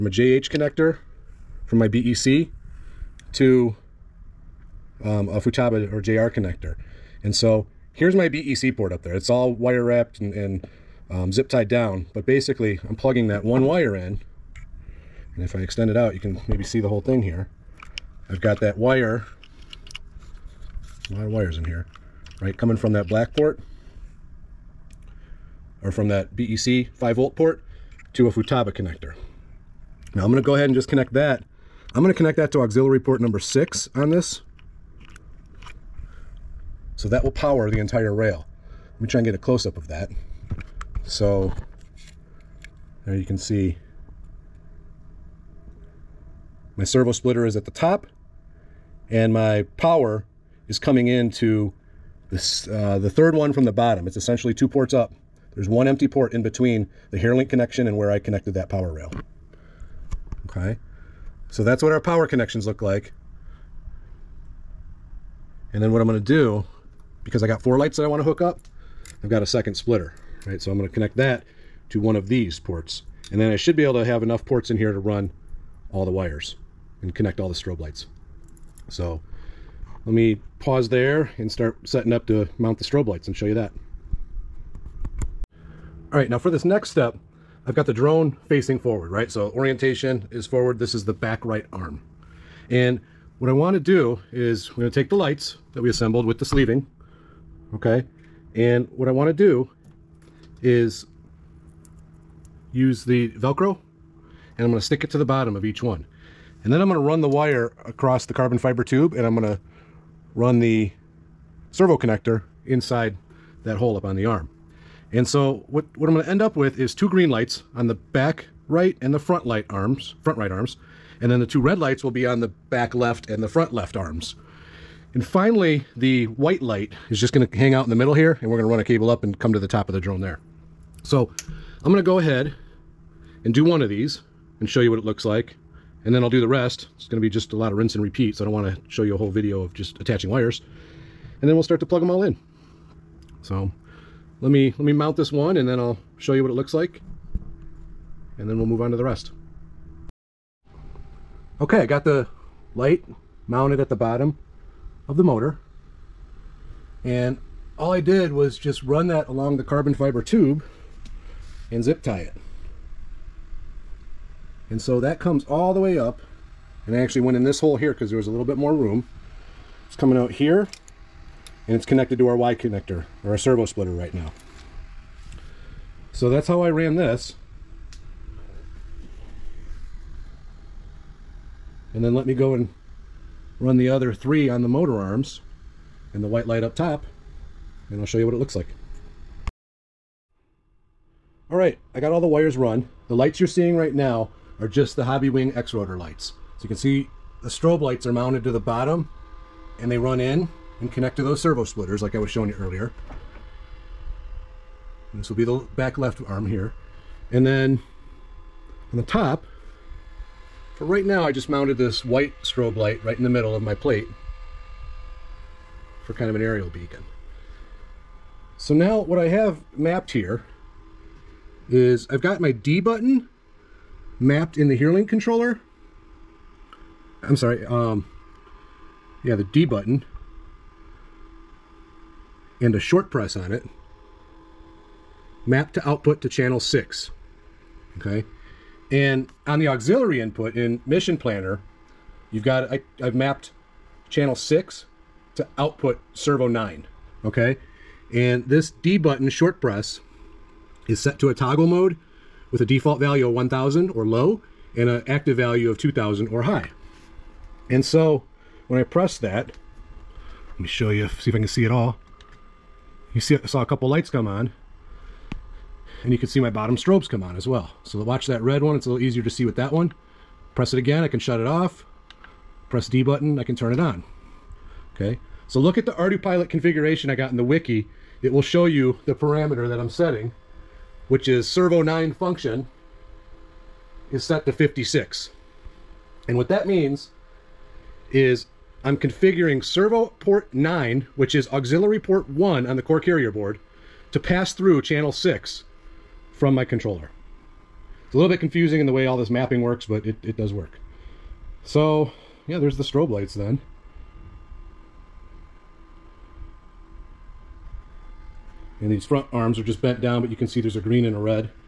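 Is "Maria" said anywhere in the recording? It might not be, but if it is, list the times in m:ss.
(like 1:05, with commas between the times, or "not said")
not said.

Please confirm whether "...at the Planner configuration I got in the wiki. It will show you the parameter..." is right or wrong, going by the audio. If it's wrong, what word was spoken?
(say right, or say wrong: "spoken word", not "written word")
wrong: "ArduPilot", not "Planner".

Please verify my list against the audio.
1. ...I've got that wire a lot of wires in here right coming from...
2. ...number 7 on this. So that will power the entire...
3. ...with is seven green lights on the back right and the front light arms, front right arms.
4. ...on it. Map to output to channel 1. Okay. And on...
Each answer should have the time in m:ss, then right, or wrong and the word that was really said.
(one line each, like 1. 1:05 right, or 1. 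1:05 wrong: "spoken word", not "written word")
1. 0:18 right
2. 0:33 wrong: "6", not "7"
3. 1:56 wrong: "two", not "seven"
4. 3:53 wrong: "6", not "1".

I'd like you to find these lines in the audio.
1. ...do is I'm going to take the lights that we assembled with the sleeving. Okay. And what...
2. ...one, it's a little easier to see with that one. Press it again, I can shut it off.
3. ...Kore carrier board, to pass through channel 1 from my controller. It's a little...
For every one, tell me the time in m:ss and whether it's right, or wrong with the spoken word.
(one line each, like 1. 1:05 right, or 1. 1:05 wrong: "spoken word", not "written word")
1. 1:33 right
2. 4:28 right
3. 4:52 wrong: "6", not "1".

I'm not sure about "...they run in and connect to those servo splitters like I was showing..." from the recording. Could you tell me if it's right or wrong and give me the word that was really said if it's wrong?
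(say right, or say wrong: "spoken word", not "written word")
right.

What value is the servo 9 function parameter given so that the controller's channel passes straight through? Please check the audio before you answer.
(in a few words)
56.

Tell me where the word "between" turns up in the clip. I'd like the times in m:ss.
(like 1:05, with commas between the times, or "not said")
0:56.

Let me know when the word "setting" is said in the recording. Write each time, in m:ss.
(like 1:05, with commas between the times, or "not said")
1:21, 4:39.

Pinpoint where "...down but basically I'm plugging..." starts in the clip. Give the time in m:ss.
0:11.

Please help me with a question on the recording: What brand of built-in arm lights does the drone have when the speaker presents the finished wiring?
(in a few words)
Hobbywing X-Rotor.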